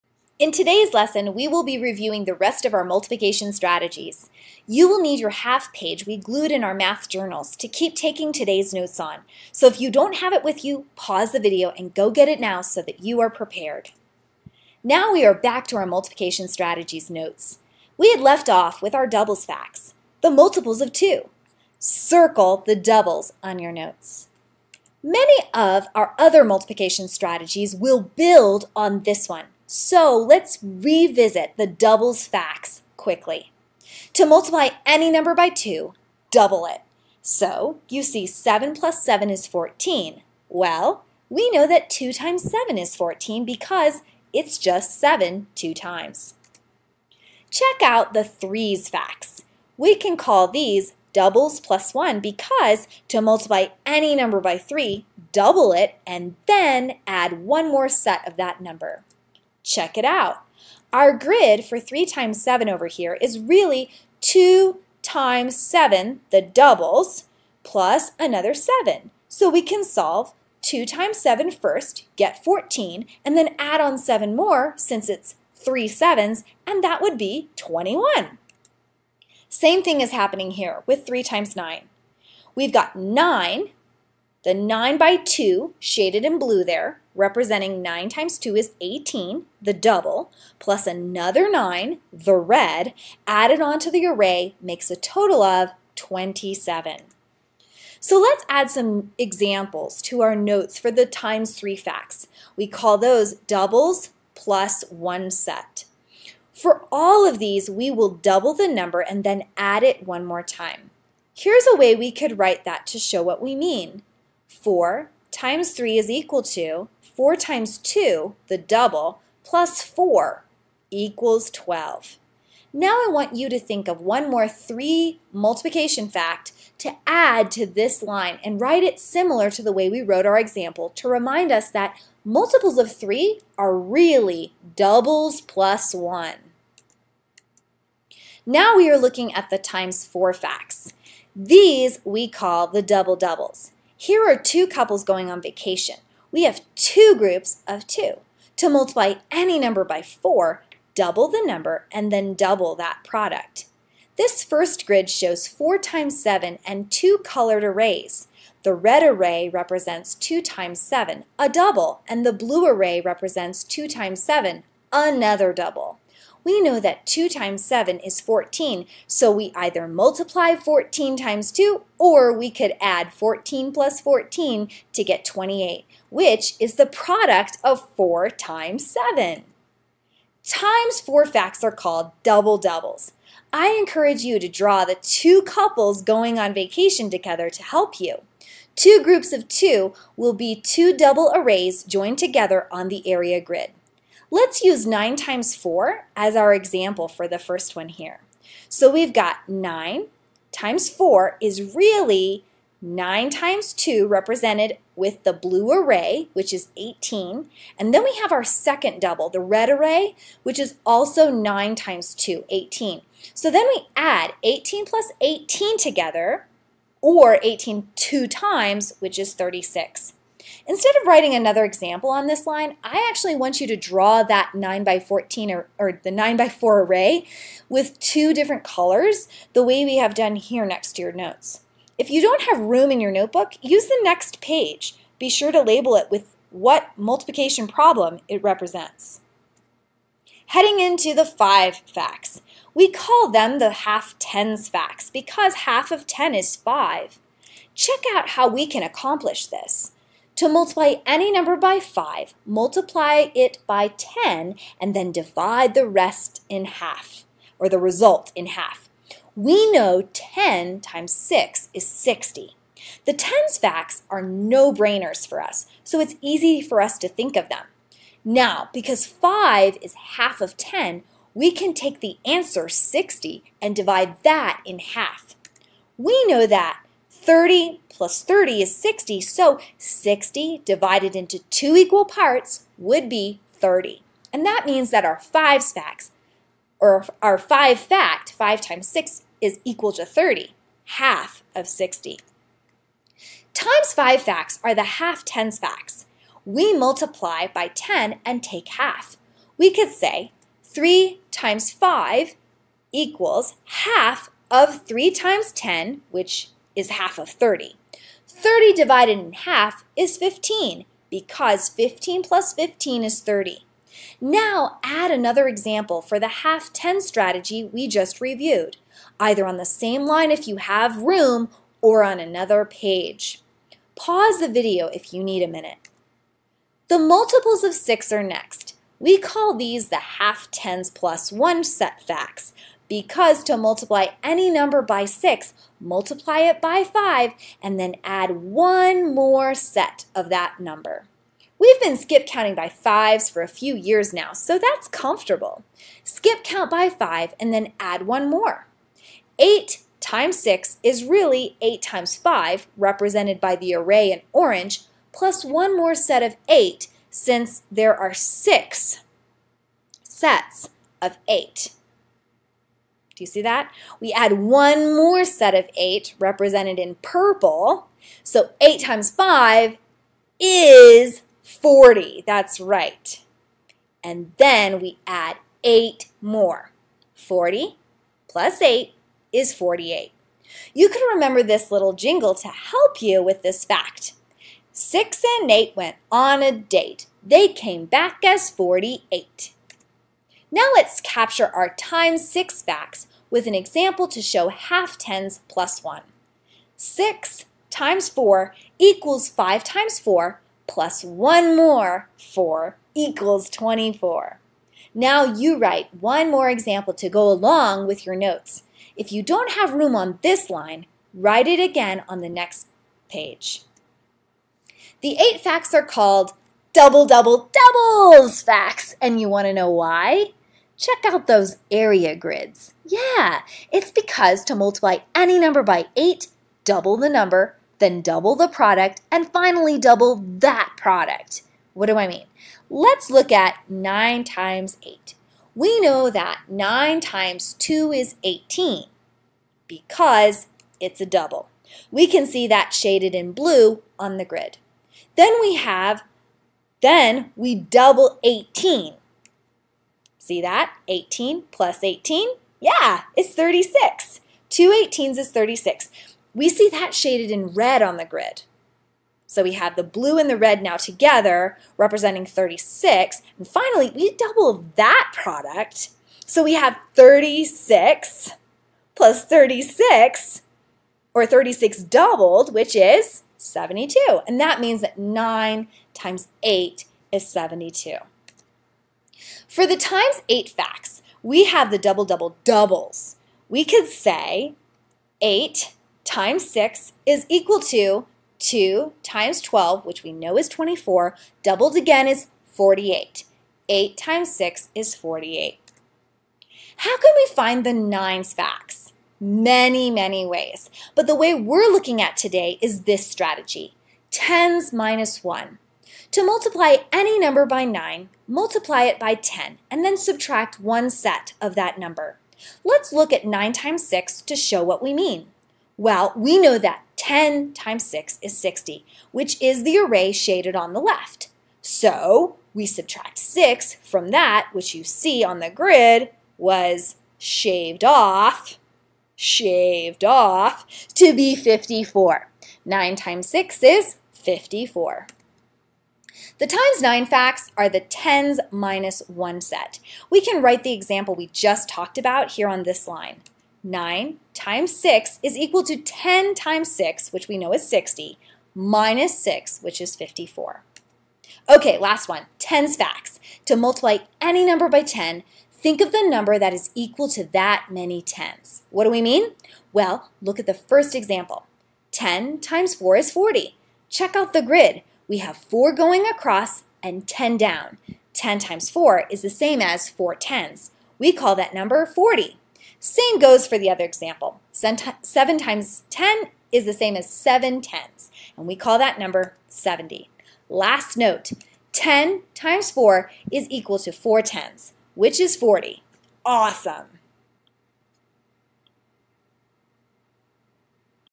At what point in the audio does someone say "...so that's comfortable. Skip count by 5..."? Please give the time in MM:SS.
05:44.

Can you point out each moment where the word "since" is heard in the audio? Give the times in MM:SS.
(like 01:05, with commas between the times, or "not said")
01:14, 05:57.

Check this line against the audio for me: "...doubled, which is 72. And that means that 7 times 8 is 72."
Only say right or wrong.
wrong.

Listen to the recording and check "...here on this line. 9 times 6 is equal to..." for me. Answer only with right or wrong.
right.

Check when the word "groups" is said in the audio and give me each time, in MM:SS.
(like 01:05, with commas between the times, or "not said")
02:27, 03:09.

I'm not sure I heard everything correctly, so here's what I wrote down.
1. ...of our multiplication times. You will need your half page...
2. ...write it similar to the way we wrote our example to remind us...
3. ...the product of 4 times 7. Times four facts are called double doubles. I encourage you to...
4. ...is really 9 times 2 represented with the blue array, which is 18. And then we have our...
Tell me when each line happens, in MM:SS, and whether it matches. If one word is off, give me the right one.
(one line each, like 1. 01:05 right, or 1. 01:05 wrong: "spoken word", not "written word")
1. 00:02 wrong: "strategies", not "times"
2. 02:08 right
3. 02:56 right
4. 03:21 right.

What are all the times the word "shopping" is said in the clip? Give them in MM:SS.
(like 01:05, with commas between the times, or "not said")
not said.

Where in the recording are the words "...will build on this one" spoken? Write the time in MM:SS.
00:27.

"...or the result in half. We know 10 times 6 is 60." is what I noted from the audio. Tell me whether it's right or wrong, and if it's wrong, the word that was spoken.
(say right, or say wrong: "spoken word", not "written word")
right.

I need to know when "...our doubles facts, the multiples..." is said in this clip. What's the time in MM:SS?
00:18.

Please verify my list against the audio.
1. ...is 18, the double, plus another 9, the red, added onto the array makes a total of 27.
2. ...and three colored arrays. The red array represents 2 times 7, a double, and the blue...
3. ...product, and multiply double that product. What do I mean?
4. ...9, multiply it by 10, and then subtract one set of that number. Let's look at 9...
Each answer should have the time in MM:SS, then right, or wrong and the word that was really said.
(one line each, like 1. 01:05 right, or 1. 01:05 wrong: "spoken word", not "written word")
1. 01:28 right
2. 02:36 wrong: "two", not "three"
3. 07:08 wrong: "finally", not "multiply"
4. 08:27 right.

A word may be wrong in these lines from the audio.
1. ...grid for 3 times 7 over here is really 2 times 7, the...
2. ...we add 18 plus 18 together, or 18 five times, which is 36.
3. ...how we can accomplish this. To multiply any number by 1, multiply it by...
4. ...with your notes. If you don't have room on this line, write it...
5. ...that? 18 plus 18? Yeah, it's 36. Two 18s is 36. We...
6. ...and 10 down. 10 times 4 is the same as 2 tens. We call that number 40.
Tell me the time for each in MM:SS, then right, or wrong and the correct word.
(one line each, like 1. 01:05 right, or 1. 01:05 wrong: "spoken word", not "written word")
1. 01:01 right
2. 03:33 wrong: "two", not "five"
3. 04:08 wrong: "5", not "1"
4. 06:47 right
5. 07:30 right
6. 09:26 wrong: "4", not "2".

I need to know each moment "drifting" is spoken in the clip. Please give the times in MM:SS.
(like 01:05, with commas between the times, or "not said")
not said.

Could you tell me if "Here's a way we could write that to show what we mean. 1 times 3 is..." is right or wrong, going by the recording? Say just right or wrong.
wrong.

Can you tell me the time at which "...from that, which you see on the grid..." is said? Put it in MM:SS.
08:43.